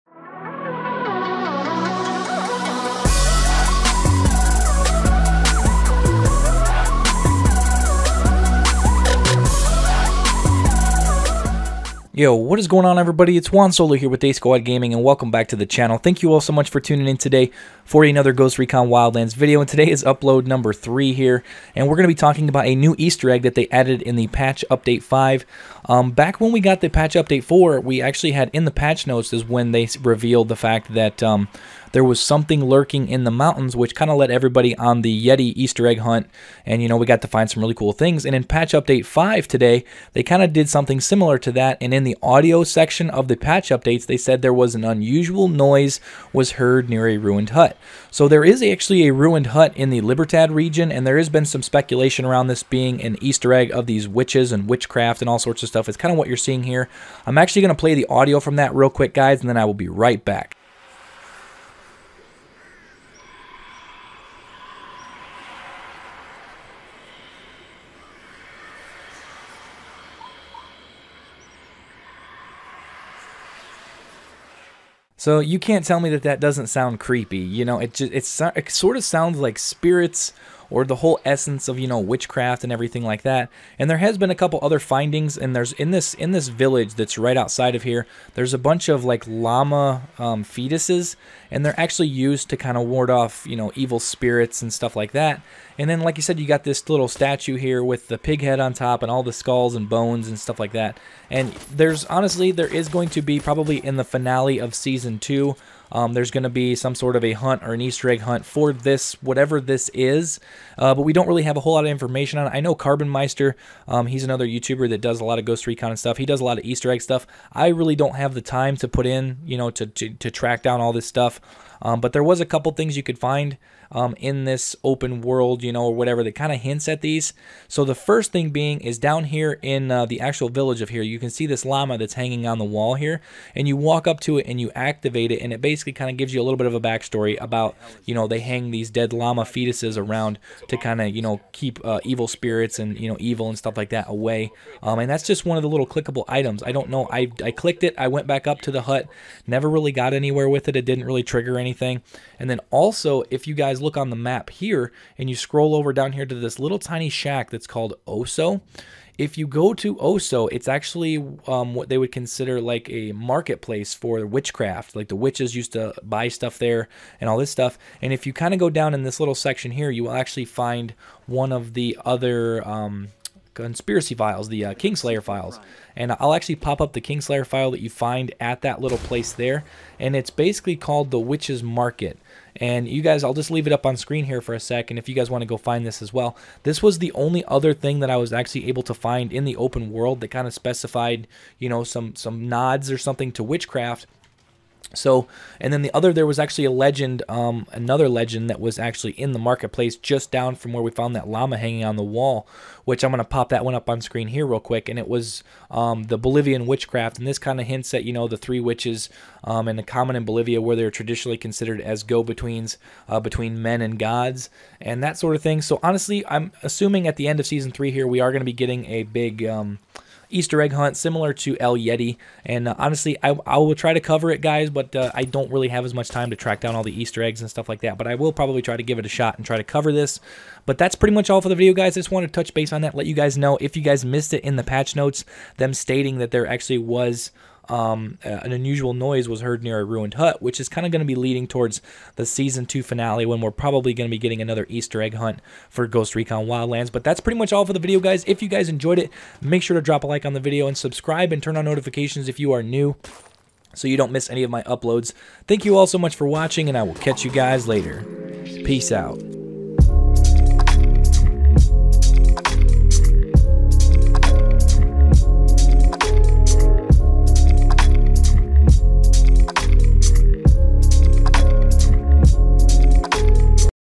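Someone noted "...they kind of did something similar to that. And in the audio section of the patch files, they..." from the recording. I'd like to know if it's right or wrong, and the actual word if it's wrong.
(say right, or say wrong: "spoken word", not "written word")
wrong: "updates", not "files".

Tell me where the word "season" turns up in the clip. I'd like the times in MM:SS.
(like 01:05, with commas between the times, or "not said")
01:44, 03:37, 04:02.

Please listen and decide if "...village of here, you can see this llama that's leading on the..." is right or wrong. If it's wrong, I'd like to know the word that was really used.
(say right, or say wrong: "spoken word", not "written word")
wrong: "hanging", not "leading".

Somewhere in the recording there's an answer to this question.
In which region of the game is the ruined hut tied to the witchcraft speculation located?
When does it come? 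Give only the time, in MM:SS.
00:50.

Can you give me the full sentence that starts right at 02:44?
Like the witches used to buy stuff there and all this stuff.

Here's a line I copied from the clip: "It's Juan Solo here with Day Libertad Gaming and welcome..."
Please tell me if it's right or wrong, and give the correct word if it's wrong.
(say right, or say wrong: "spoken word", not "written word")
wrong: "Squad", not "Libertad".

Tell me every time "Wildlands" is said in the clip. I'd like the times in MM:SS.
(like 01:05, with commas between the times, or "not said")
00:18, 04:06.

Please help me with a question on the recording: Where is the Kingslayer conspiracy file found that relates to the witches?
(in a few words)
Witch's Market.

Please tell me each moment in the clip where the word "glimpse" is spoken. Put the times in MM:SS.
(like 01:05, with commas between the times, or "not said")
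not said.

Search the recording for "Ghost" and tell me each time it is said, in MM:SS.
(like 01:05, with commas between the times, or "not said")
00:18, 01:55, 04:05.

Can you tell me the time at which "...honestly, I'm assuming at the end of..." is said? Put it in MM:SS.
03:35.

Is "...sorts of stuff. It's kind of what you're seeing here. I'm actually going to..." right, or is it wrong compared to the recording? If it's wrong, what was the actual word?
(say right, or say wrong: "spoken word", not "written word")
right.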